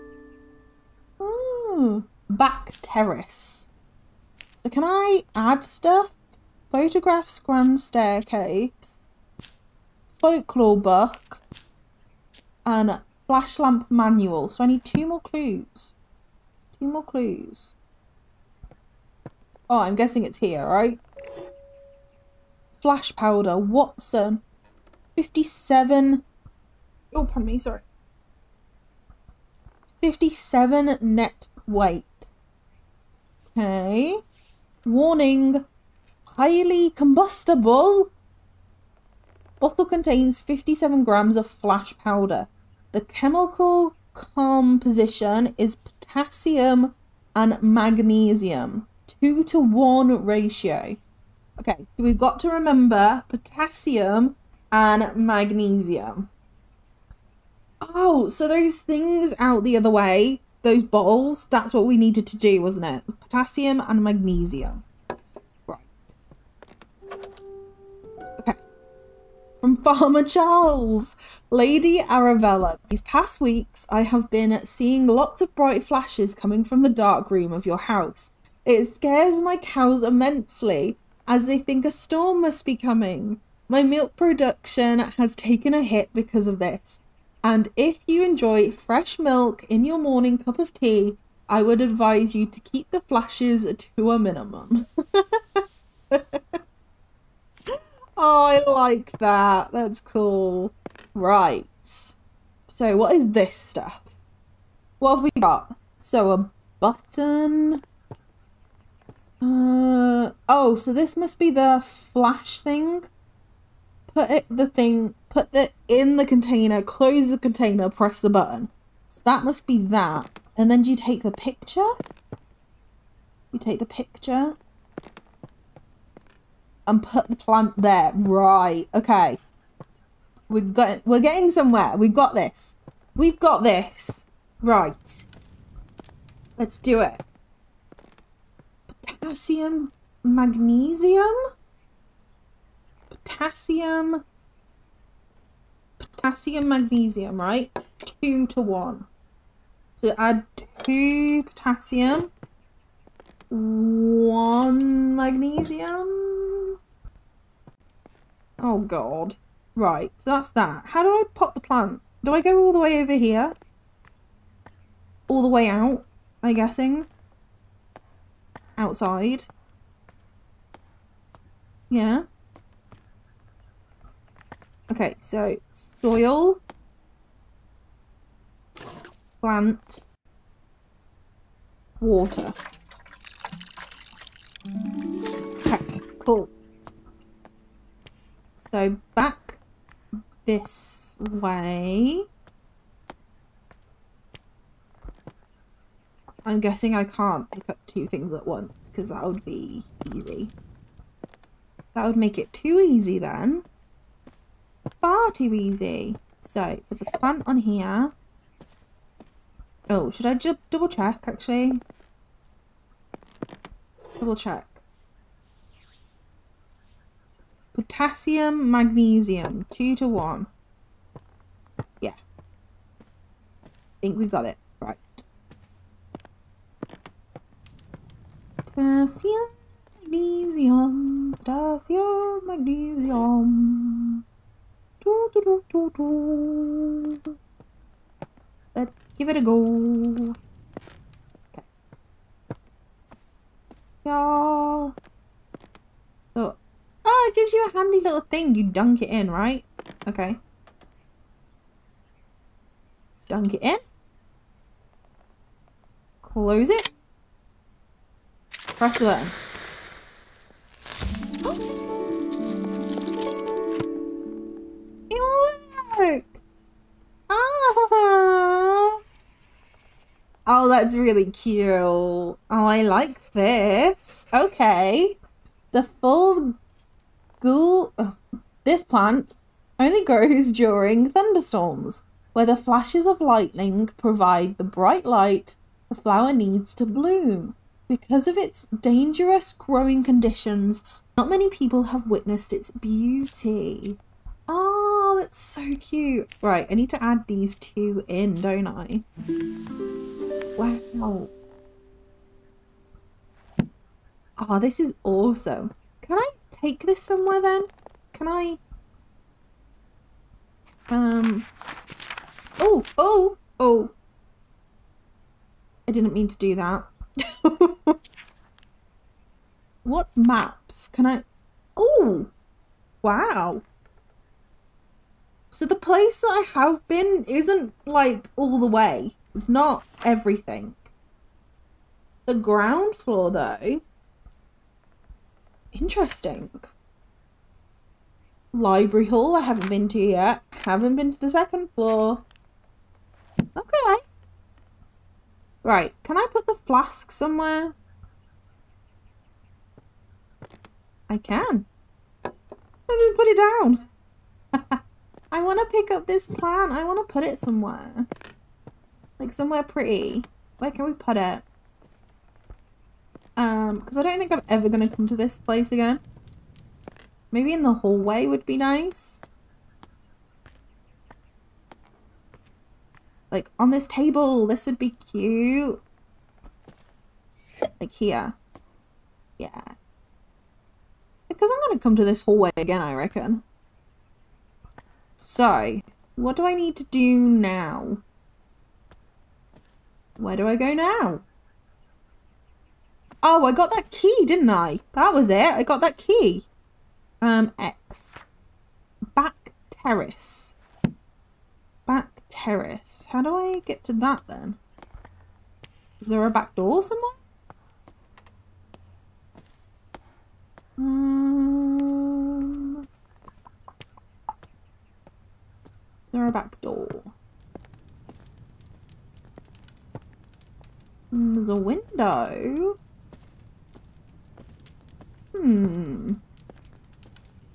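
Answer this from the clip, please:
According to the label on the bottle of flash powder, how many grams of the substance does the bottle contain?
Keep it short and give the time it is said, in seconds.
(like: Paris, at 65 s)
57, at 40 s.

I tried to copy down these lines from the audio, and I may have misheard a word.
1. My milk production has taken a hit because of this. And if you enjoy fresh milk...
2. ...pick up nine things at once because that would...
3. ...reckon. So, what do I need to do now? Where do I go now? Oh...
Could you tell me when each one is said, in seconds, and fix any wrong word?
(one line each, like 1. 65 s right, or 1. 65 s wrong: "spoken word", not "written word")
1. 83 s right
2. 197 s wrong: "two", not "nine"
3. 382 s right.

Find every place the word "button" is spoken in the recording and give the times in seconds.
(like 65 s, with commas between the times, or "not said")
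106 s, 118 s, 259 s.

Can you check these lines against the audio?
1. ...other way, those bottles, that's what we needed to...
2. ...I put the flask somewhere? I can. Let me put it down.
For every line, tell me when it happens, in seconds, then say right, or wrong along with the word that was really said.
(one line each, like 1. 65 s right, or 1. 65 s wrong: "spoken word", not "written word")
1. 59 s right
2. 346 s right.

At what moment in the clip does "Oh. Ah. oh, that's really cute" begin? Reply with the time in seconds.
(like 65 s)
267 s.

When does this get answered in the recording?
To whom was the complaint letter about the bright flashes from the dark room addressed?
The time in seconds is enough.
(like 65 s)
71 s.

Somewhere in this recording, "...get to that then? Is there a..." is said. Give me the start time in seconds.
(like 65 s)
403 s.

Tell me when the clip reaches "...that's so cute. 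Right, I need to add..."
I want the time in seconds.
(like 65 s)
295 s.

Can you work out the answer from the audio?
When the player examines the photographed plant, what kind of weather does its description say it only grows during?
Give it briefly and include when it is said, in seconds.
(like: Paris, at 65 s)
Thunderstorms, at 281 s.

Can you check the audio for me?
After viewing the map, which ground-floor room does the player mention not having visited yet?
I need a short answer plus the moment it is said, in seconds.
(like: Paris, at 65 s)
Library hall, at 338 s.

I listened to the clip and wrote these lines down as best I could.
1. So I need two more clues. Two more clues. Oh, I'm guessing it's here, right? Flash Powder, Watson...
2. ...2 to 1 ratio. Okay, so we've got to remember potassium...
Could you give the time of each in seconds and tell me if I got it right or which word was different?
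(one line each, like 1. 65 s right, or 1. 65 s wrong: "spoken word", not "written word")
1. 14 s right
2. 49 s right.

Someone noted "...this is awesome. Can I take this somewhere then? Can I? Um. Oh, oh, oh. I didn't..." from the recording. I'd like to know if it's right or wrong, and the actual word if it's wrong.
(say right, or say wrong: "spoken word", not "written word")
right.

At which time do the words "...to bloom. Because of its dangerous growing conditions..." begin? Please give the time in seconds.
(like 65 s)
286 s.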